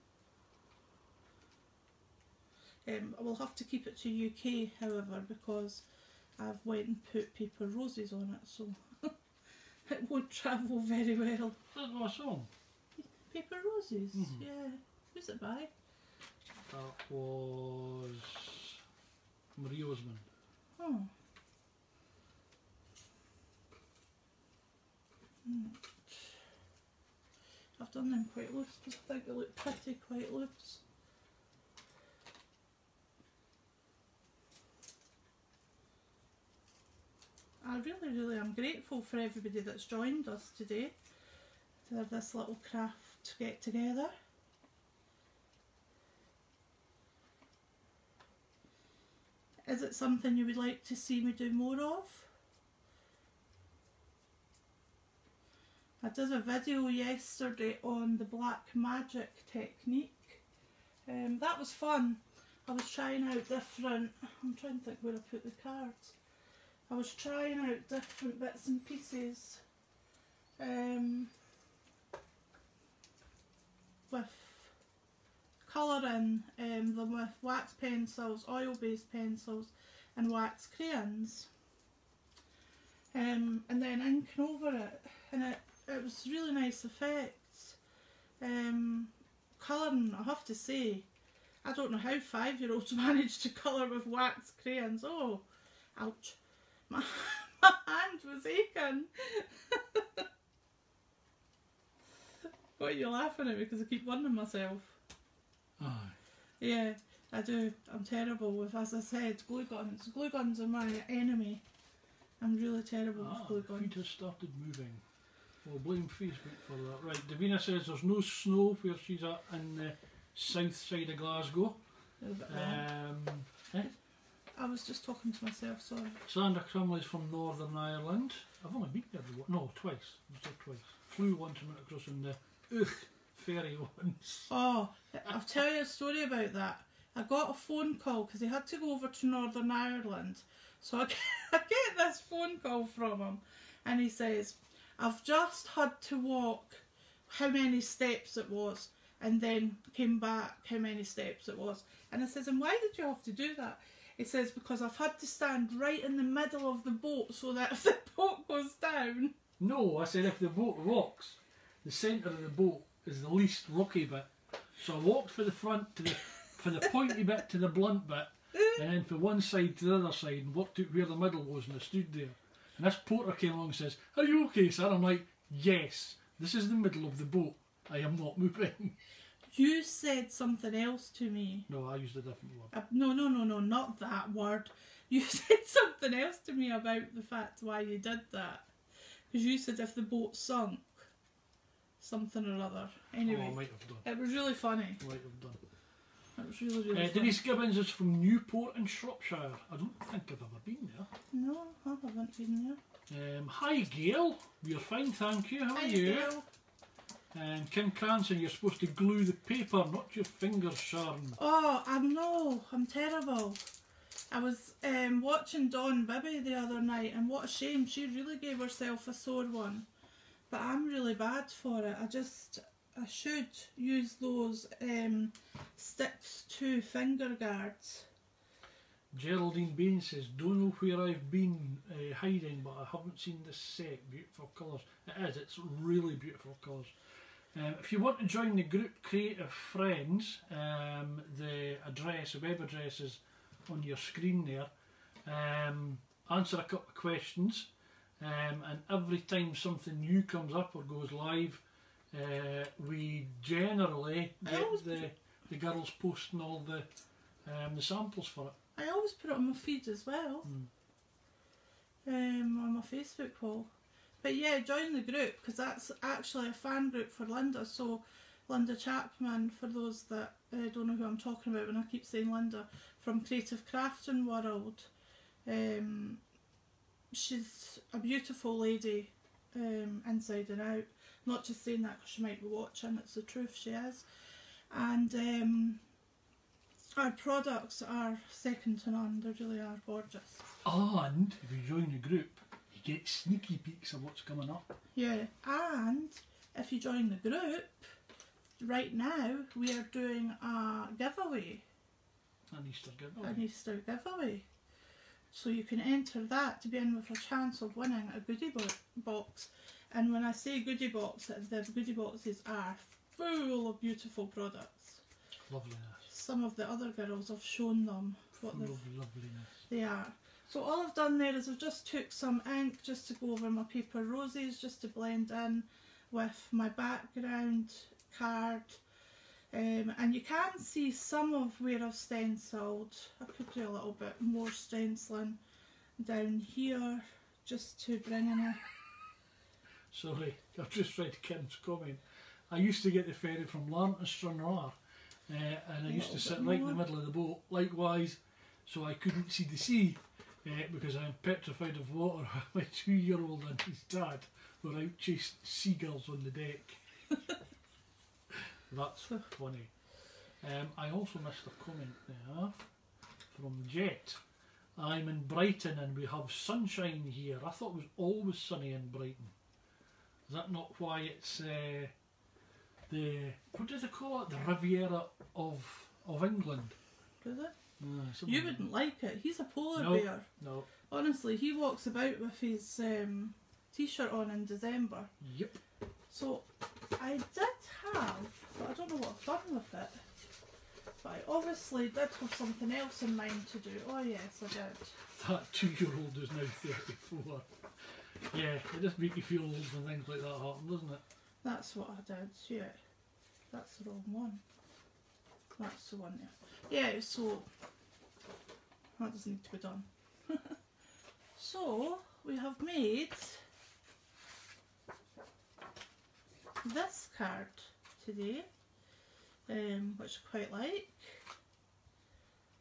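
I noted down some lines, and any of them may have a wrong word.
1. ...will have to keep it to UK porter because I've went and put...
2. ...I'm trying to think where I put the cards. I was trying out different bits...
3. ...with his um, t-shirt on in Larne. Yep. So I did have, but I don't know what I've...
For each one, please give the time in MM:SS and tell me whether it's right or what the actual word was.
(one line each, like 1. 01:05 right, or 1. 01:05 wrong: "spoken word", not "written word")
1. 00:03 wrong: "however", not "porter"
2. 01:04 right
3. 06:22 wrong: "December", not "Larne".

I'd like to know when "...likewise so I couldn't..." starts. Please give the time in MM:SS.
05:47.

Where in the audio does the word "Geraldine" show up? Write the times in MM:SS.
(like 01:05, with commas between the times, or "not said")
03:49.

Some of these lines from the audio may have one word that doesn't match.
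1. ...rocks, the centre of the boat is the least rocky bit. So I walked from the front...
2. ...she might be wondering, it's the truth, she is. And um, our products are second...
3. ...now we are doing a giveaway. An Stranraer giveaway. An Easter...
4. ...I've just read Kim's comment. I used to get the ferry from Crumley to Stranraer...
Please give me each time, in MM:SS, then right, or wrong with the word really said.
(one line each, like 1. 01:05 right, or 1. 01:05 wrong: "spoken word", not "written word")
1. 02:40 right
2. 04:42 wrong: "watching", not "wondering"
3. 04:58 wrong: "Easter", not "Stranraer"
4. 05:40 wrong: "Larne", not "Crumley".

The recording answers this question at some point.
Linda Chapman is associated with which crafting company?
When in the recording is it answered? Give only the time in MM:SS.
04:33.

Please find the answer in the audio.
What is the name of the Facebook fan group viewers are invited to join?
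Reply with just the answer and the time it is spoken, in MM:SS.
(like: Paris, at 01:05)
Creative Friends, at 03:59.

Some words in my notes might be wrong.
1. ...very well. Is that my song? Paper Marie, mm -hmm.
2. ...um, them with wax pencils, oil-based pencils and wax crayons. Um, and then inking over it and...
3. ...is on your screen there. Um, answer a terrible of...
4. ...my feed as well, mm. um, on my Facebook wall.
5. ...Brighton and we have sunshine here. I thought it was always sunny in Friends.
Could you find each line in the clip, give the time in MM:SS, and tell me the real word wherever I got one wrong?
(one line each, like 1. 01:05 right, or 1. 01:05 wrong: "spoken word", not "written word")
1. 00:10 wrong: "Roses", not "Marie"
2. 01:16 right
3. 04:02 wrong: "couple", not "terrible"
4. 04:19 right
5. 06:05 wrong: "Brighton", not "Friends".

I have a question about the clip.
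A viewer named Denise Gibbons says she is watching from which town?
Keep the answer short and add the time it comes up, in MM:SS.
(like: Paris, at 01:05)
Newport, at 03:18.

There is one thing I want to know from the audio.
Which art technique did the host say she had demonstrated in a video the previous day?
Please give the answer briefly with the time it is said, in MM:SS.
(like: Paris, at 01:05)
black magic technique, at 00:58.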